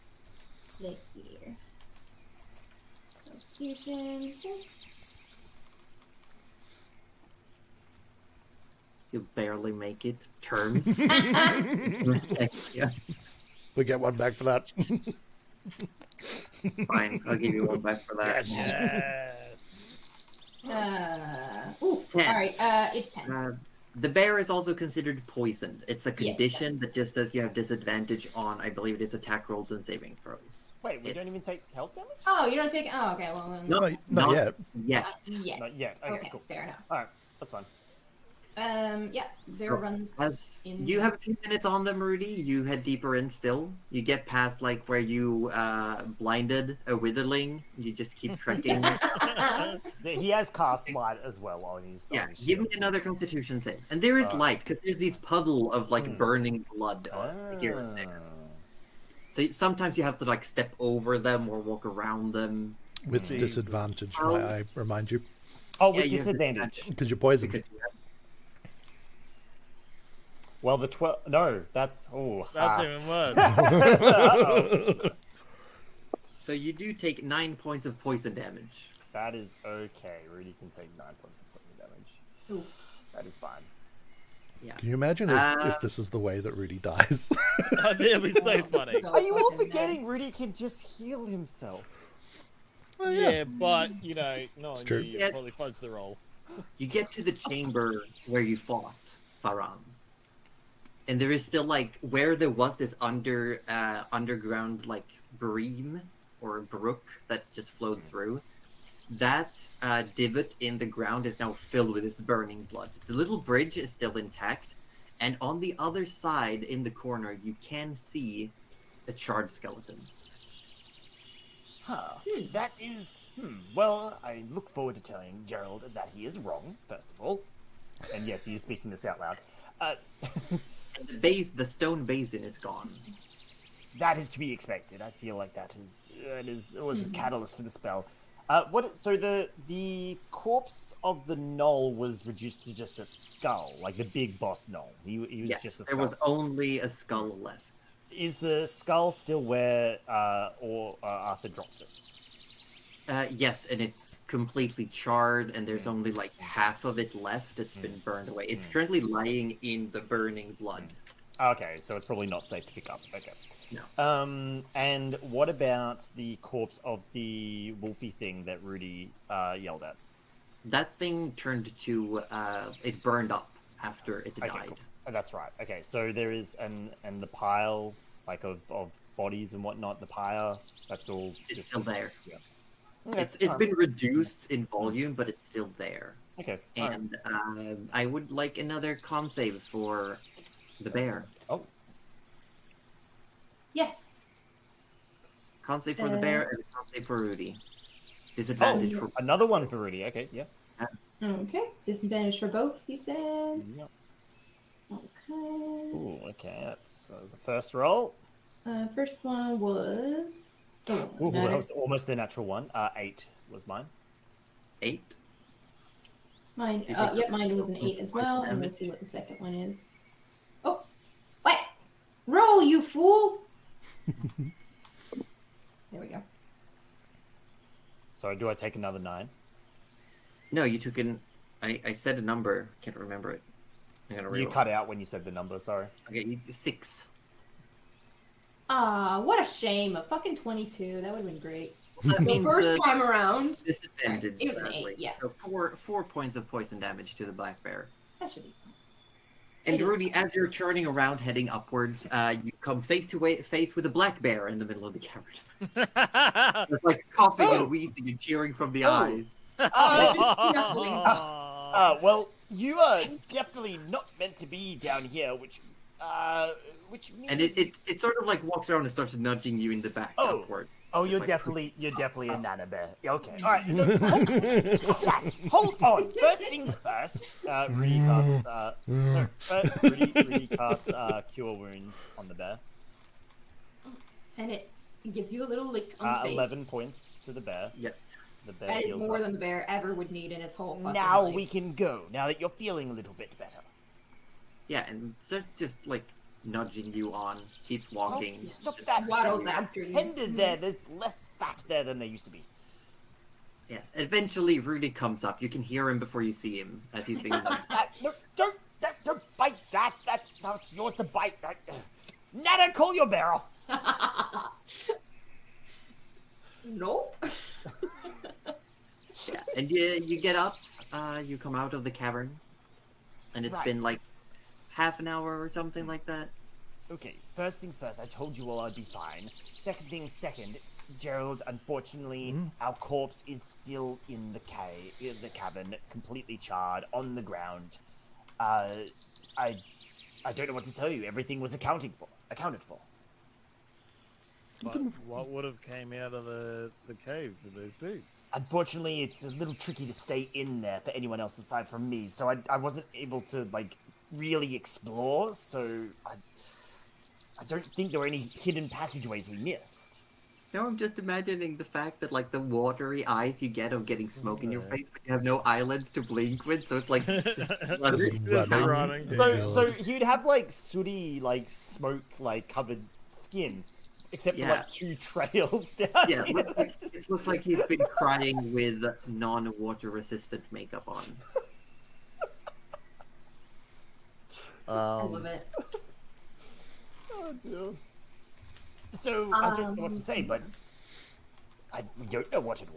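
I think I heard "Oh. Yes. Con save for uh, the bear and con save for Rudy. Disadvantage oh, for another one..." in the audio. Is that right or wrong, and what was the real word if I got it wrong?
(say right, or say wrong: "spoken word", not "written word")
right.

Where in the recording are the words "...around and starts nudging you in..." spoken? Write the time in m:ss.
4:28.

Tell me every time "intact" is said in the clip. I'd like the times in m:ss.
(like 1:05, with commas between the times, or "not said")
1:54.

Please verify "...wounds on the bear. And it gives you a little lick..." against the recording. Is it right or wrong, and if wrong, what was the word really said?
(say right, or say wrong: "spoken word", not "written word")
right.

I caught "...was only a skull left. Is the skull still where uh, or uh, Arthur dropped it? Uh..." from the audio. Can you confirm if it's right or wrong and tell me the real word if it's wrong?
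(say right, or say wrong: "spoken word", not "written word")
right.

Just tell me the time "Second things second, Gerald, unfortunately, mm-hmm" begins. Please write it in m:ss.
5:29.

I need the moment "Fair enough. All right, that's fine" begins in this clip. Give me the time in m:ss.
0:36.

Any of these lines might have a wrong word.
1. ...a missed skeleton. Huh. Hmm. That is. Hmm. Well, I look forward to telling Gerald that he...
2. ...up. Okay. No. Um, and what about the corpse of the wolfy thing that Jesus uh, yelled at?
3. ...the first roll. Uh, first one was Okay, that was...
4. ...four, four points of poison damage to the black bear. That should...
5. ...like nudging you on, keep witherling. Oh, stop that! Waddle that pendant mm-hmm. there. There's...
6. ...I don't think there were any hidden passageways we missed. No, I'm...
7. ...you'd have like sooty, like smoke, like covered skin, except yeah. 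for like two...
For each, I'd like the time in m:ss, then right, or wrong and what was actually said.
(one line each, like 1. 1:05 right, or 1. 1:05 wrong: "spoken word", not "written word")
1. 1:59 wrong: "charred", not "missed"
2. 2:42 wrong: "Rudy", not "Jesus"
3. 3:27 wrong: "Ooh", not "Okay"
4. 4:05 right
5. 4:55 wrong: "walking", not "witherling"
6. 5:57 right
7. 6:09 right.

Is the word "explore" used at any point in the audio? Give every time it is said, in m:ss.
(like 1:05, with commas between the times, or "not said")
5:54.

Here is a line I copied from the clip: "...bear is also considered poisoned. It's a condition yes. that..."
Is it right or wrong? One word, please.
right.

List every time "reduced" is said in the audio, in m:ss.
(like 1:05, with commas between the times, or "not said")
2:22, 3:03.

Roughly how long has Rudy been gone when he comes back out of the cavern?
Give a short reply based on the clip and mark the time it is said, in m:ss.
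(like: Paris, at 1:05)
Half an hour, at 5:24.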